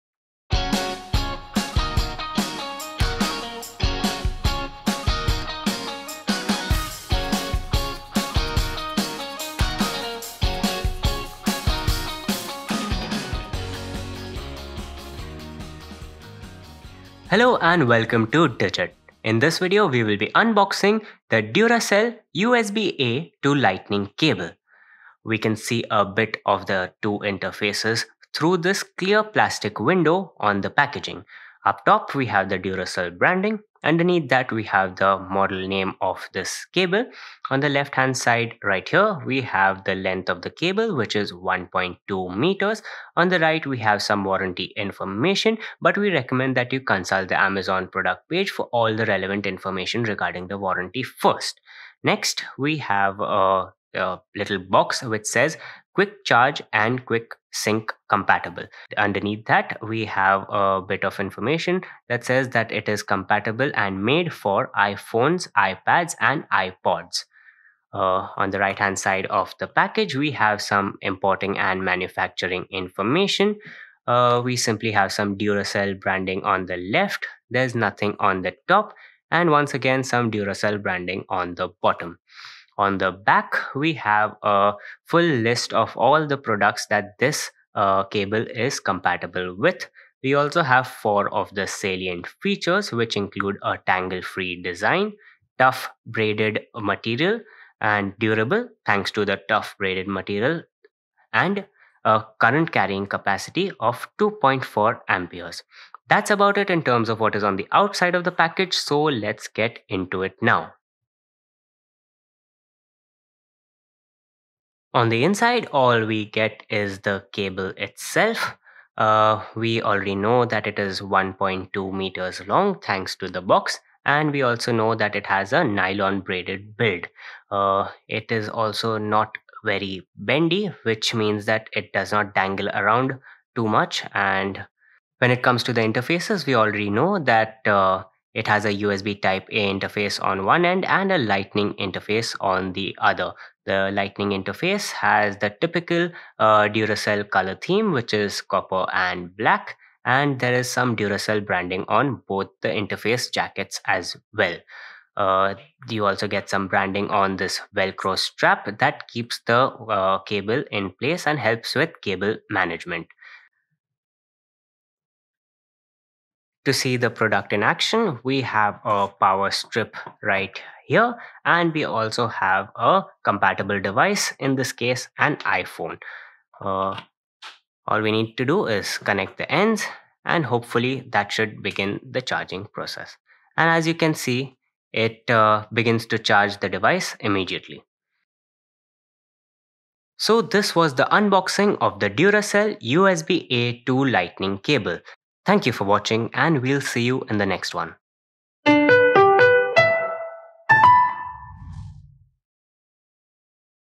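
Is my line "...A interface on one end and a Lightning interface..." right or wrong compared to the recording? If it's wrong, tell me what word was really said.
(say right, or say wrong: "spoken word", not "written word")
right.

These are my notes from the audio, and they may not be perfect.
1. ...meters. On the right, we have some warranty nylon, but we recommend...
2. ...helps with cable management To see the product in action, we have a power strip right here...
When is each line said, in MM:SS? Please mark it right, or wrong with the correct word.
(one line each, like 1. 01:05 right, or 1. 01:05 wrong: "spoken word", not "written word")
1. 00:42 wrong: "information", not "nylon"
2. 02:41 right.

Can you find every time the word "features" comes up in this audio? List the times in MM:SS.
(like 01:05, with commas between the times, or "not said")
01:32.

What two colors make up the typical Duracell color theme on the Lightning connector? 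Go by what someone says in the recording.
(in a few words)
copper and black.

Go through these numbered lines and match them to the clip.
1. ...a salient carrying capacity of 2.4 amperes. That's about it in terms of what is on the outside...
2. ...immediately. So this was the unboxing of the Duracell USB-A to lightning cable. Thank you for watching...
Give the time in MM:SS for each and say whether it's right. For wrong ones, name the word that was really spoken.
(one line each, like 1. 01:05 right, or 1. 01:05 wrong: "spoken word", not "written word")
1. 01:42 wrong: "current", not "salient"
2. 03:07 right.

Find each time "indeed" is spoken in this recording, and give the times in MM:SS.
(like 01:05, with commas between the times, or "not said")
not said.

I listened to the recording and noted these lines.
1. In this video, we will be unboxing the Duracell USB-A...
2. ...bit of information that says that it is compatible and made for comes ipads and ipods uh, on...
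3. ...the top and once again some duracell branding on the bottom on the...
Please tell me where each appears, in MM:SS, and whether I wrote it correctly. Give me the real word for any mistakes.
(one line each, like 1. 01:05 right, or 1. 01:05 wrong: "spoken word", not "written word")
1. 00:19 right
2. 01:00 wrong: "iphones", not "comes"
3. 01:18 right.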